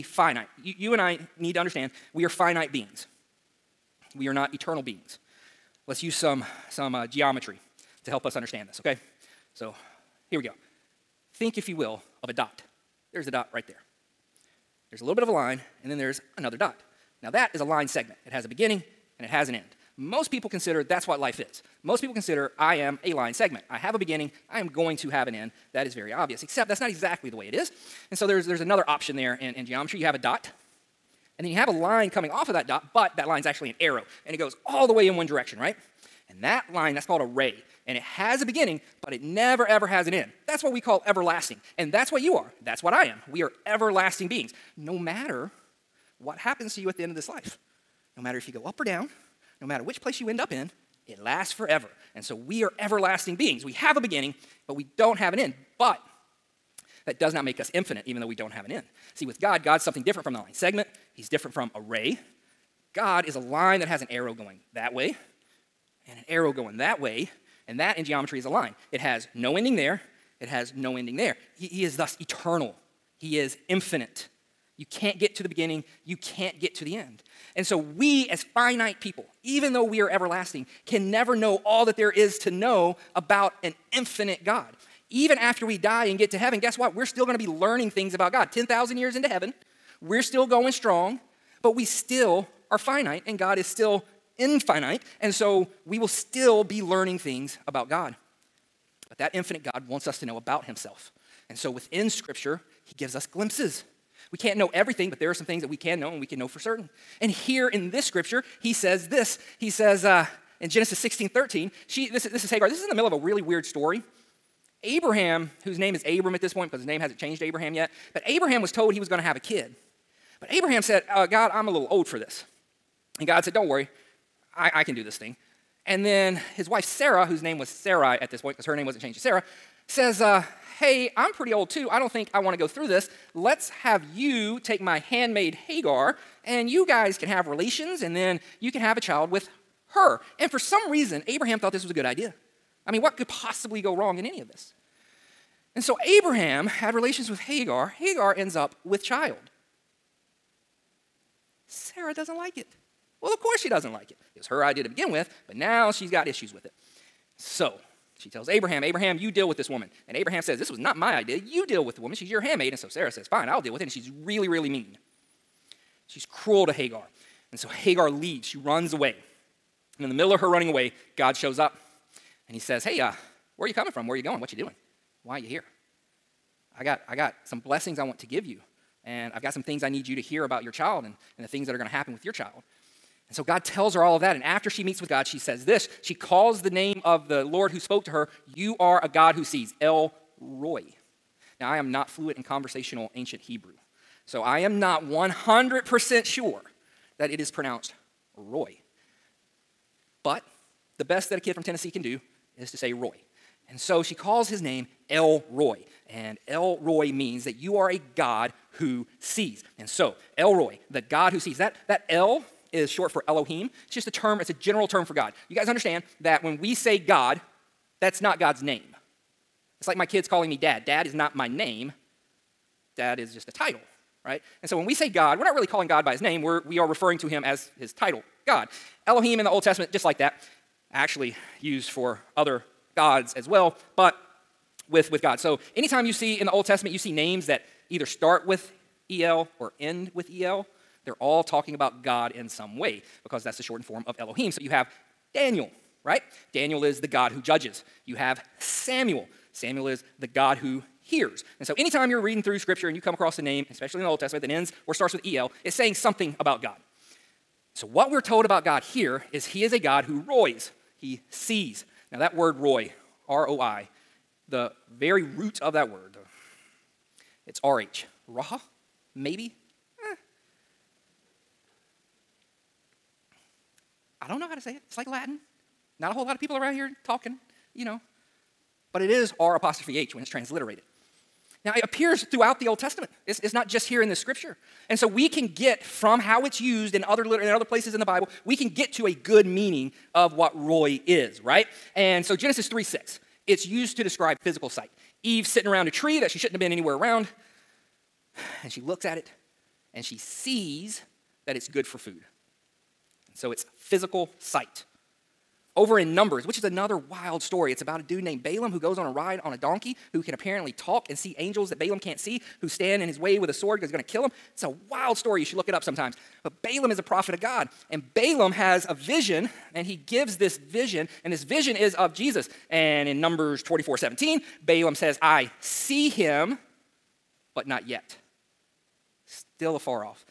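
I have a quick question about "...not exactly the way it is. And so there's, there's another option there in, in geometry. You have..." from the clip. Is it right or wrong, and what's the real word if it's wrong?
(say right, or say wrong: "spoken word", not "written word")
right.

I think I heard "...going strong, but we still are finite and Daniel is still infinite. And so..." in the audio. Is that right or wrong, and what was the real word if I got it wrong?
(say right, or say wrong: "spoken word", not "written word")
wrong: "God", not "Daniel".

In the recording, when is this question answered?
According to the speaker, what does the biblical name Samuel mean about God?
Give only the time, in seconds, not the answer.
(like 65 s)
250 s.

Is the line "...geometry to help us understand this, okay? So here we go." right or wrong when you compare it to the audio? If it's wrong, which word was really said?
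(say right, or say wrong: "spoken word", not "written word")
right.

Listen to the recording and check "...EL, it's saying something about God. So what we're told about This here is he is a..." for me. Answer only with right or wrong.
wrong.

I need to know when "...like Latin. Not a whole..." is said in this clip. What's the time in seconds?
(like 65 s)
274 s.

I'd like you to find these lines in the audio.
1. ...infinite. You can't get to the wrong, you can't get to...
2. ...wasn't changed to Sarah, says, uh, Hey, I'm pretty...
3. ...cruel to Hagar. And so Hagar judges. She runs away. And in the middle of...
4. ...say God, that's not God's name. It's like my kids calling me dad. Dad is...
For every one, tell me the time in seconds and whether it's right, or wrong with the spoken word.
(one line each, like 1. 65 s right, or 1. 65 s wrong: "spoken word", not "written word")
1. 73 s wrong: "beginning", not "wrong"
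2. 128 s right
3. 166 s wrong: "leaves", not "judges"
4. 216 s right.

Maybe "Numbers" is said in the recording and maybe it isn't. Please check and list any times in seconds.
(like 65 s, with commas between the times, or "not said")
306 s, 323 s.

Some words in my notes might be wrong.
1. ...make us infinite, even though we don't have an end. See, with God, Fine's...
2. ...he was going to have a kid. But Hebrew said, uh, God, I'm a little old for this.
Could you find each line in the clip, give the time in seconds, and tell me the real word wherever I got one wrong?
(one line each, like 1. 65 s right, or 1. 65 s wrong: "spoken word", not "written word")
1. 57 s wrong: "God", not "Fine"
2. 118 s wrong: "Abraham", not "Hebrew".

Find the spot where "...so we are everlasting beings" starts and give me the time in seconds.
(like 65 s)
52 s.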